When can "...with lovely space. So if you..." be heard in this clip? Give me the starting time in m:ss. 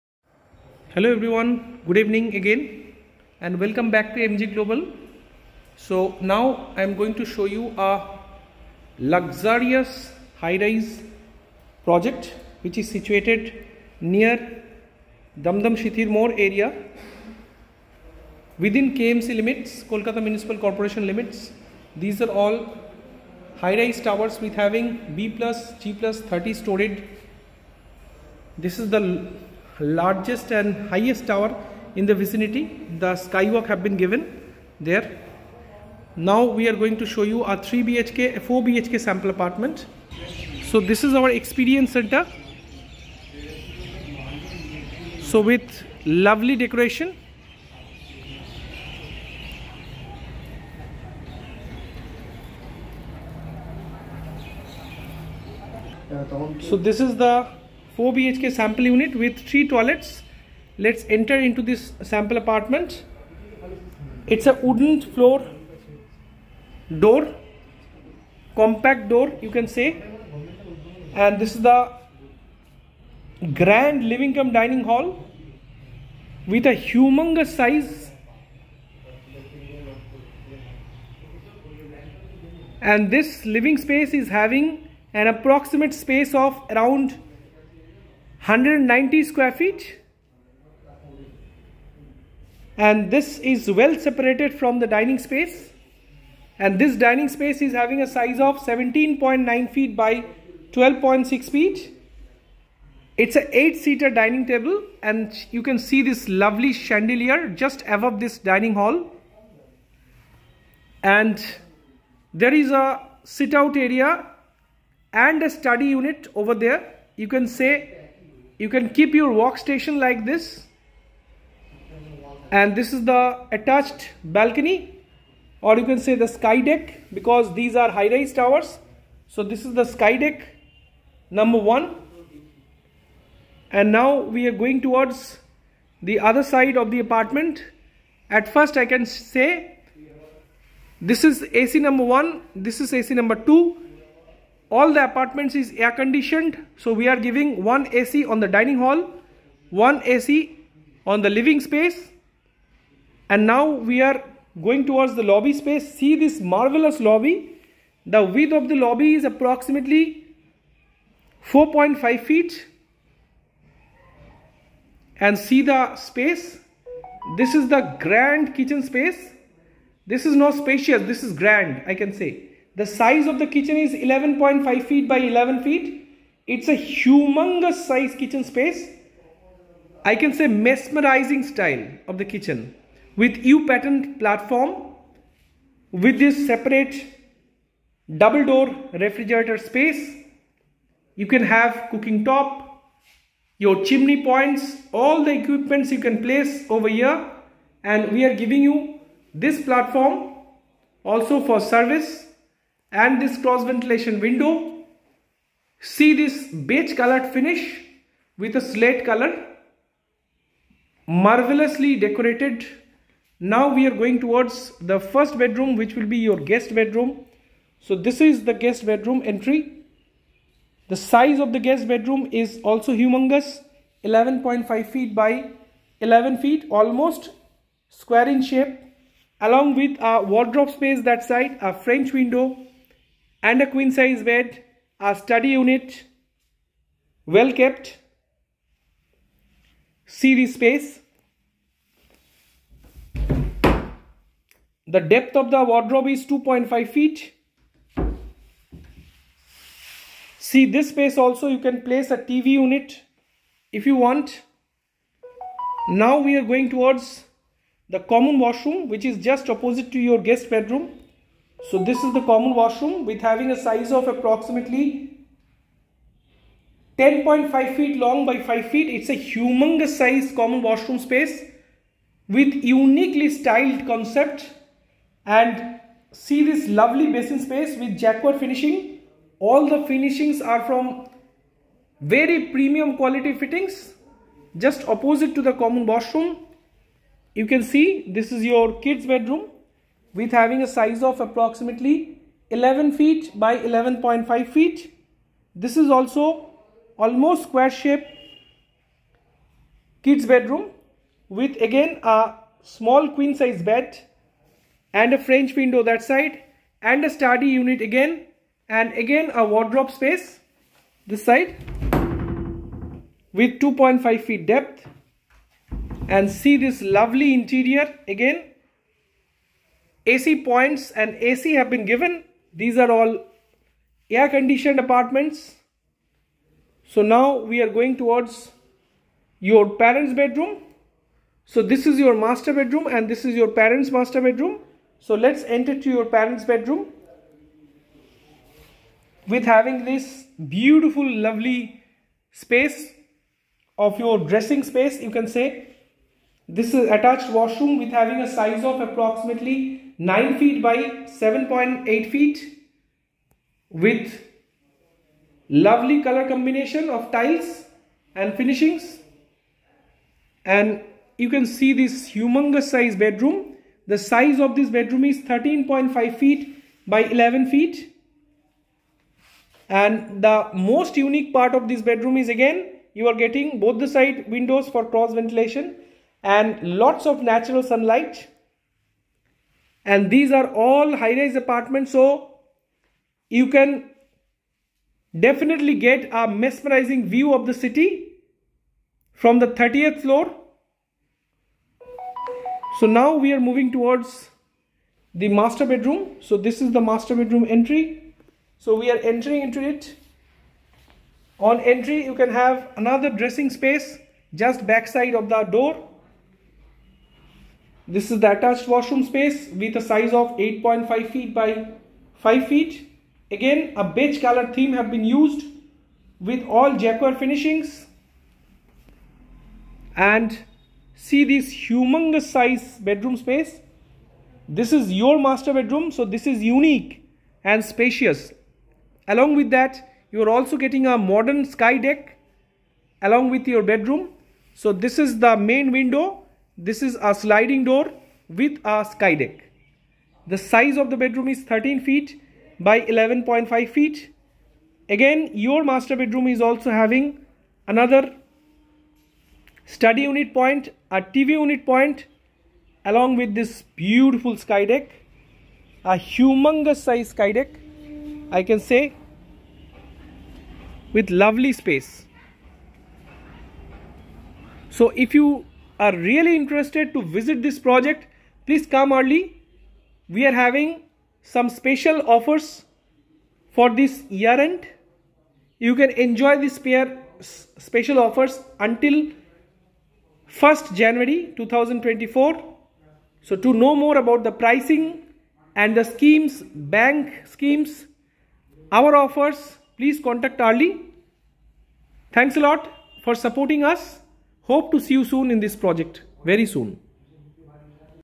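7:40.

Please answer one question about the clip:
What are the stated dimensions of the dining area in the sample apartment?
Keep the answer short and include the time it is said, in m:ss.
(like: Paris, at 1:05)
17.9 feet by 12.6 feet, at 1:38.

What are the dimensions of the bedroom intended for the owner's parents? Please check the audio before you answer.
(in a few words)
13.5 feet by 11 feet.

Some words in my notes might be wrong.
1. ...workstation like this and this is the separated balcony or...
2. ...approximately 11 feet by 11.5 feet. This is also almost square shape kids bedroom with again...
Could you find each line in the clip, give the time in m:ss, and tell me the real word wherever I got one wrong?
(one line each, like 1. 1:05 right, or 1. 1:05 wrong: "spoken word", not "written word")
1. 1:59 wrong: "attached", not "separated"
2. 4:51 right.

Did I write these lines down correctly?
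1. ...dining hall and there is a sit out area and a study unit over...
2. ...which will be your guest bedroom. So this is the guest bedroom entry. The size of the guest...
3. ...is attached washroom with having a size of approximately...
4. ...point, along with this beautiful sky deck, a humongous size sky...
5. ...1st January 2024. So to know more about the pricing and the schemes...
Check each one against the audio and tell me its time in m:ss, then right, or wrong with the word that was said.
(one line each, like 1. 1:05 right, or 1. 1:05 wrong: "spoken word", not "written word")
1. 1:48 right
2. 3:35 right
3. 5:46 right
4. 7:31 right
5. 8:00 right.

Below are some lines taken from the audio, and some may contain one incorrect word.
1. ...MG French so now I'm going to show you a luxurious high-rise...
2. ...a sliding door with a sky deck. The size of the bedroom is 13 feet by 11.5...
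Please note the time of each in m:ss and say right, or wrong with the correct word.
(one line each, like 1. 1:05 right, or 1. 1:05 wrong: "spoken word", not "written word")
1. 0:04 wrong: "Global", not "French"
2. 7:17 right.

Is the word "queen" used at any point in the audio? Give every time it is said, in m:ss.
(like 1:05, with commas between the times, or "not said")
3:53, 5:03.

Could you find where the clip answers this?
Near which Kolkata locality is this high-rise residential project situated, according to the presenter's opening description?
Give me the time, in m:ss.
0:15.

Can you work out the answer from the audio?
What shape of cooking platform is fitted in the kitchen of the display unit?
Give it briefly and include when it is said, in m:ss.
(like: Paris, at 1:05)
U-patterned, at 3:03.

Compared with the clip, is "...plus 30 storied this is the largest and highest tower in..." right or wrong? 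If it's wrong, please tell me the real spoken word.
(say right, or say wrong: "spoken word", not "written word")
right.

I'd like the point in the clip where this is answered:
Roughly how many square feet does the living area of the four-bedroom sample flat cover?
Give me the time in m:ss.
1:28.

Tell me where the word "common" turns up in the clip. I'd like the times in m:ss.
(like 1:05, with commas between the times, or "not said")
4:18, 4:22, 4:30, 4:45.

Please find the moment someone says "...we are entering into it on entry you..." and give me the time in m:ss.
6:38.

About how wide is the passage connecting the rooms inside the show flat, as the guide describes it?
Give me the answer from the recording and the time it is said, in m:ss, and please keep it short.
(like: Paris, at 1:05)
4.5 feet, at 2:41.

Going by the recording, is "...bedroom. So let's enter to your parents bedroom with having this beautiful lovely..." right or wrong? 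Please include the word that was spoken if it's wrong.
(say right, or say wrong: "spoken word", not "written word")
right.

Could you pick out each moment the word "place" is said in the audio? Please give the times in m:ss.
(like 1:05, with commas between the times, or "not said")
3:16, 4:11.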